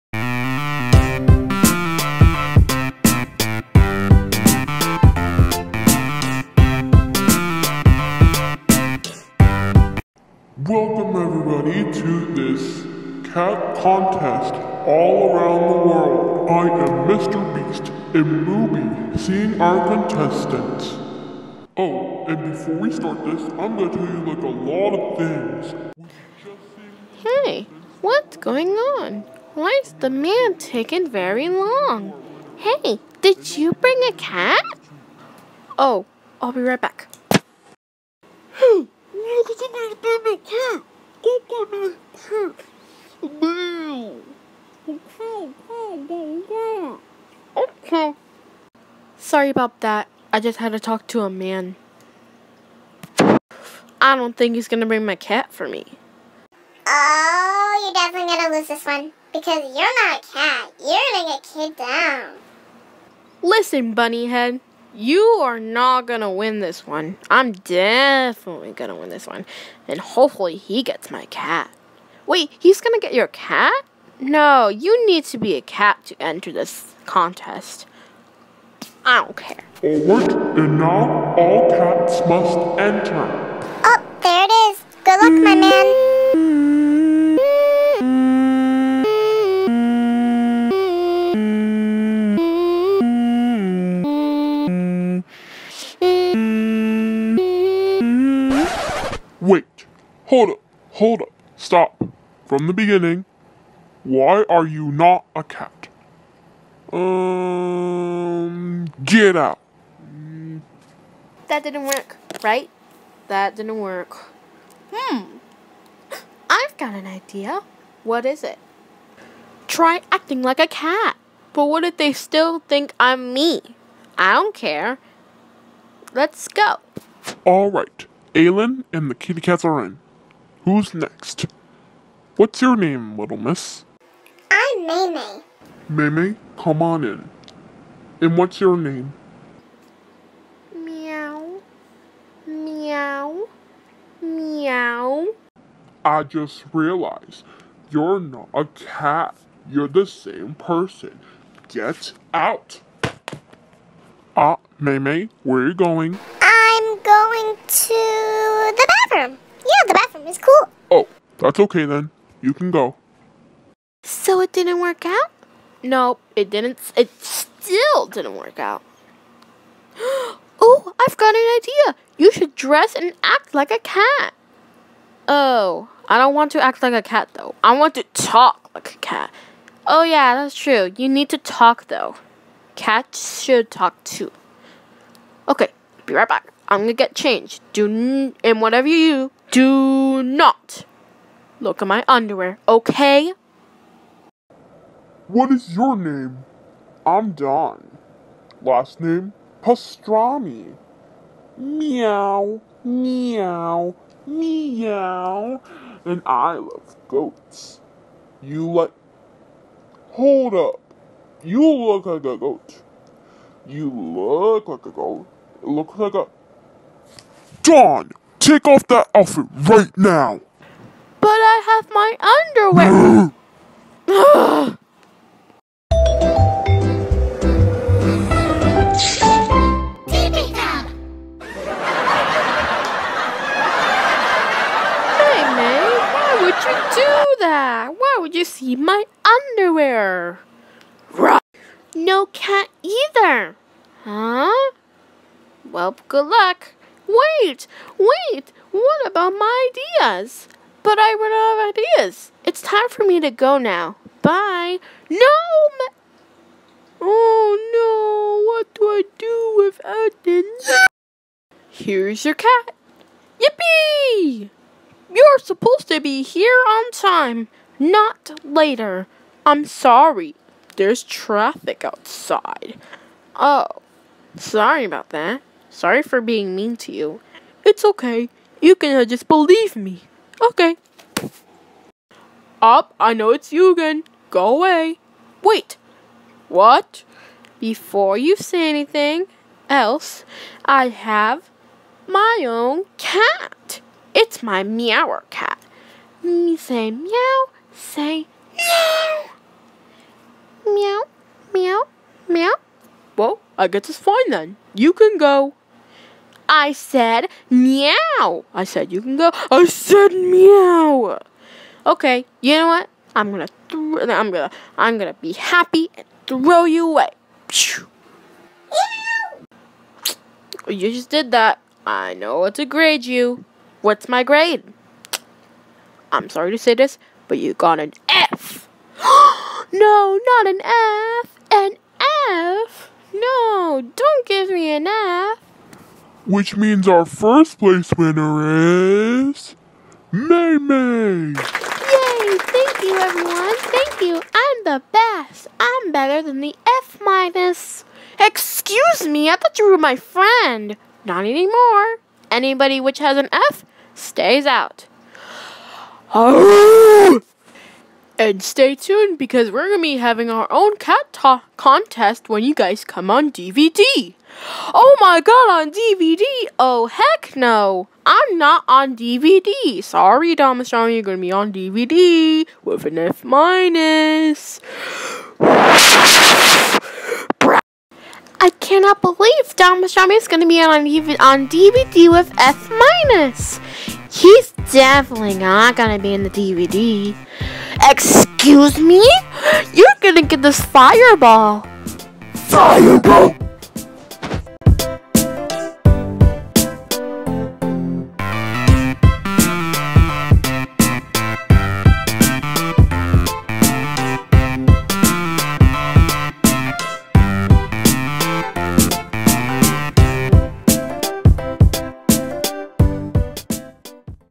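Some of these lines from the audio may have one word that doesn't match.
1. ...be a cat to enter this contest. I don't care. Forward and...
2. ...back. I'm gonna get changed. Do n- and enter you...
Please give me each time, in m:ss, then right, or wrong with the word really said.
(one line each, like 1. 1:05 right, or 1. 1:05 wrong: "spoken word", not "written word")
1. 1:15 right
2. 3:06 wrong: "whatever", not "enter".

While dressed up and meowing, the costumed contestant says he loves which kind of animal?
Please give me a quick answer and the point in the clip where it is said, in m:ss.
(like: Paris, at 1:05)
goats, at 3:27.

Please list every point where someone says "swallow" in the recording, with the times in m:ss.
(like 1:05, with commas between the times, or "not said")
not said.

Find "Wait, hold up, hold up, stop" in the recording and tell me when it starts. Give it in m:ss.
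1:39.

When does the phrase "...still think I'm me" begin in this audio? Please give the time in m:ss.
2:02.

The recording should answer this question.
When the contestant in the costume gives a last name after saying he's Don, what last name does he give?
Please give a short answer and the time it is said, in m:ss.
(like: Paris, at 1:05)
Pastrami, at 3:19.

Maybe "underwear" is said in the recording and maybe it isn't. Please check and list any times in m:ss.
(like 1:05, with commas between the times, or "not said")
3:12, 3:44, 3:59.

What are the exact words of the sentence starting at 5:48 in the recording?
Excuse me, I thought you were my friend!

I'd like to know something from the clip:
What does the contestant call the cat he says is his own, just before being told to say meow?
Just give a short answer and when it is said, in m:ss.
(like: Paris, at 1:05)
meower cat, at 4:54.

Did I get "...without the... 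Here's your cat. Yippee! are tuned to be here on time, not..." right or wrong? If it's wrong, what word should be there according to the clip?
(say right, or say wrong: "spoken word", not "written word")
wrong: "supposed", not "tuned".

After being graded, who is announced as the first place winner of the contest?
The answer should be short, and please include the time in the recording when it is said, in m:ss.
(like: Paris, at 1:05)
May May, at 5:40.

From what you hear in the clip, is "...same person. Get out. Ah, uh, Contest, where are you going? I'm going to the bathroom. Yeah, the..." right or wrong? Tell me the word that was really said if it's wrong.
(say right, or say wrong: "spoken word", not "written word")
wrong: "Meme", not "Contest".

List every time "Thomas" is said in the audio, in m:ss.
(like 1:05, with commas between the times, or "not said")
6:10, 6:19.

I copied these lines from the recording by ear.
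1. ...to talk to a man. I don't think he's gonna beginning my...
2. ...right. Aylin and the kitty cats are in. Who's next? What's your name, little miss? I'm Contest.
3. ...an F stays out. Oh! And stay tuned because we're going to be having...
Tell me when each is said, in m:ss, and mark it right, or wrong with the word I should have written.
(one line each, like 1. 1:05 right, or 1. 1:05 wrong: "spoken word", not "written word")
1. 0:50 wrong: "bring", not "beginning"
2. 2:07 wrong: "Maymay", not "Contest"
3. 5:53 right.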